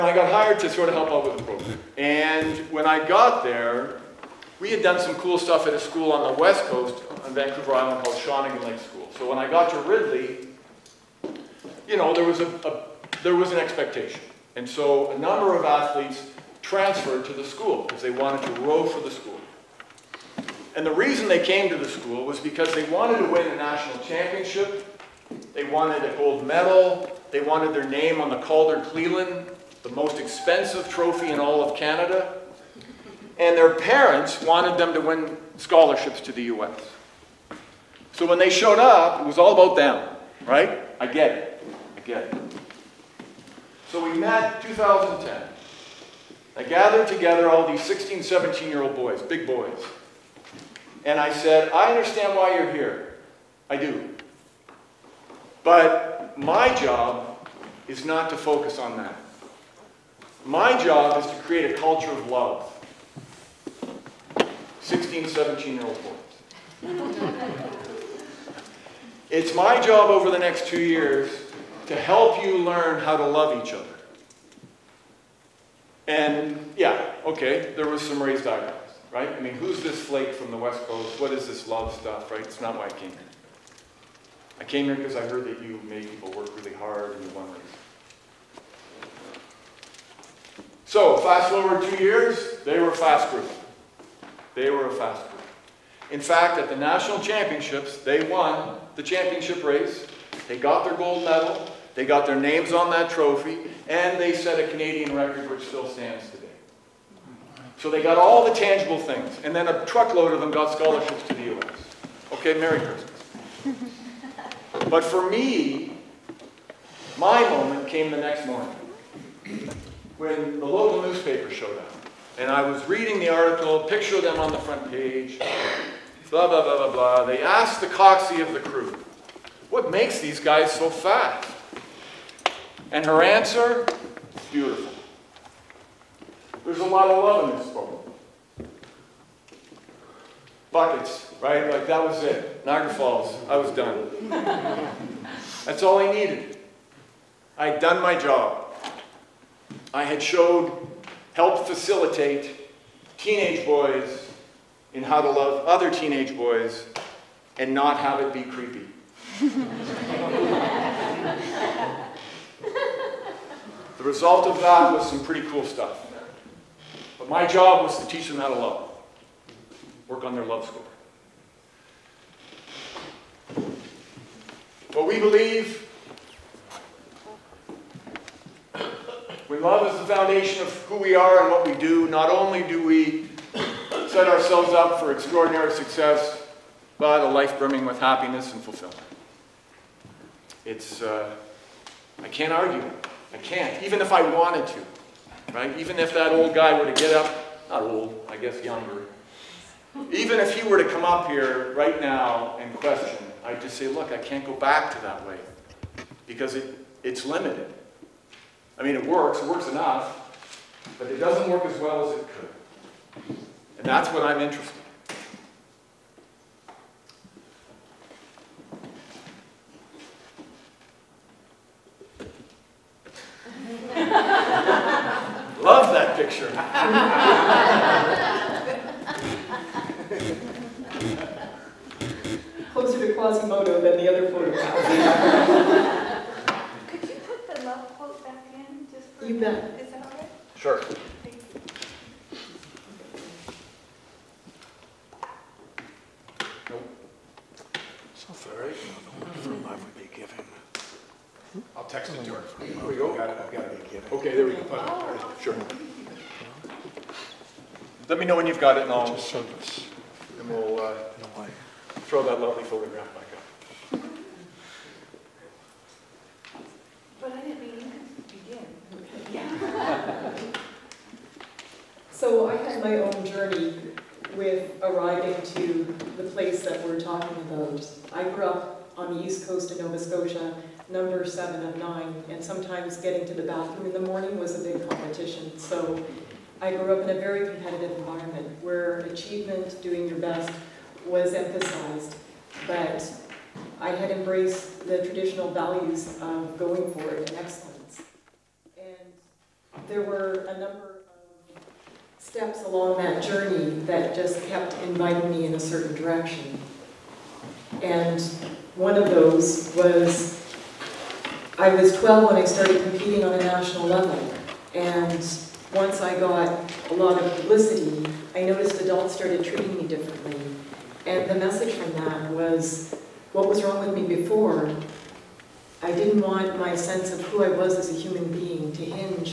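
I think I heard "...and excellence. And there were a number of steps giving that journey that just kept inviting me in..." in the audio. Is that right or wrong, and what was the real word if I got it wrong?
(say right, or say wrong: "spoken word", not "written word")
wrong: "along", not "giving".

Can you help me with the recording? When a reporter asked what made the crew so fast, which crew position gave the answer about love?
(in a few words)
The coxie.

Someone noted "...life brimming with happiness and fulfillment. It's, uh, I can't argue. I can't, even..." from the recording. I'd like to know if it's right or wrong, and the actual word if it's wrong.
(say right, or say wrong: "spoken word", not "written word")
right.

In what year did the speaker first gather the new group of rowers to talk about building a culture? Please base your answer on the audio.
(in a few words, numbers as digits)
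2010.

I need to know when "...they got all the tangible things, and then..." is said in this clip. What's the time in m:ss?
1:47.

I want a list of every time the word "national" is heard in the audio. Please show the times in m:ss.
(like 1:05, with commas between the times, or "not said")
0:23, 1:36, 5:13.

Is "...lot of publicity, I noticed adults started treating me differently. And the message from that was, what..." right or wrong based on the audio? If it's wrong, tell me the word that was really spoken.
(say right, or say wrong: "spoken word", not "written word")
right.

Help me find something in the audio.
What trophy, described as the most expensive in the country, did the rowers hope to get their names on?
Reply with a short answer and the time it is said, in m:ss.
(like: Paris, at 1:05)
Calder Cleland, at 0:28.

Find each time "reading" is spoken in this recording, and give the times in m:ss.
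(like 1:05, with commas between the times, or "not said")
2:02.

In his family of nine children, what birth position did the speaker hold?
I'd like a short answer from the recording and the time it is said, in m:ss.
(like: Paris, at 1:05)
7, at 4:41.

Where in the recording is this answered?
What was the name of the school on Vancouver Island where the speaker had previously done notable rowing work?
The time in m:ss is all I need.
0:08.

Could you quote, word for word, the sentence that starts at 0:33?
And their parents wanted them to win scholarships to the U.S.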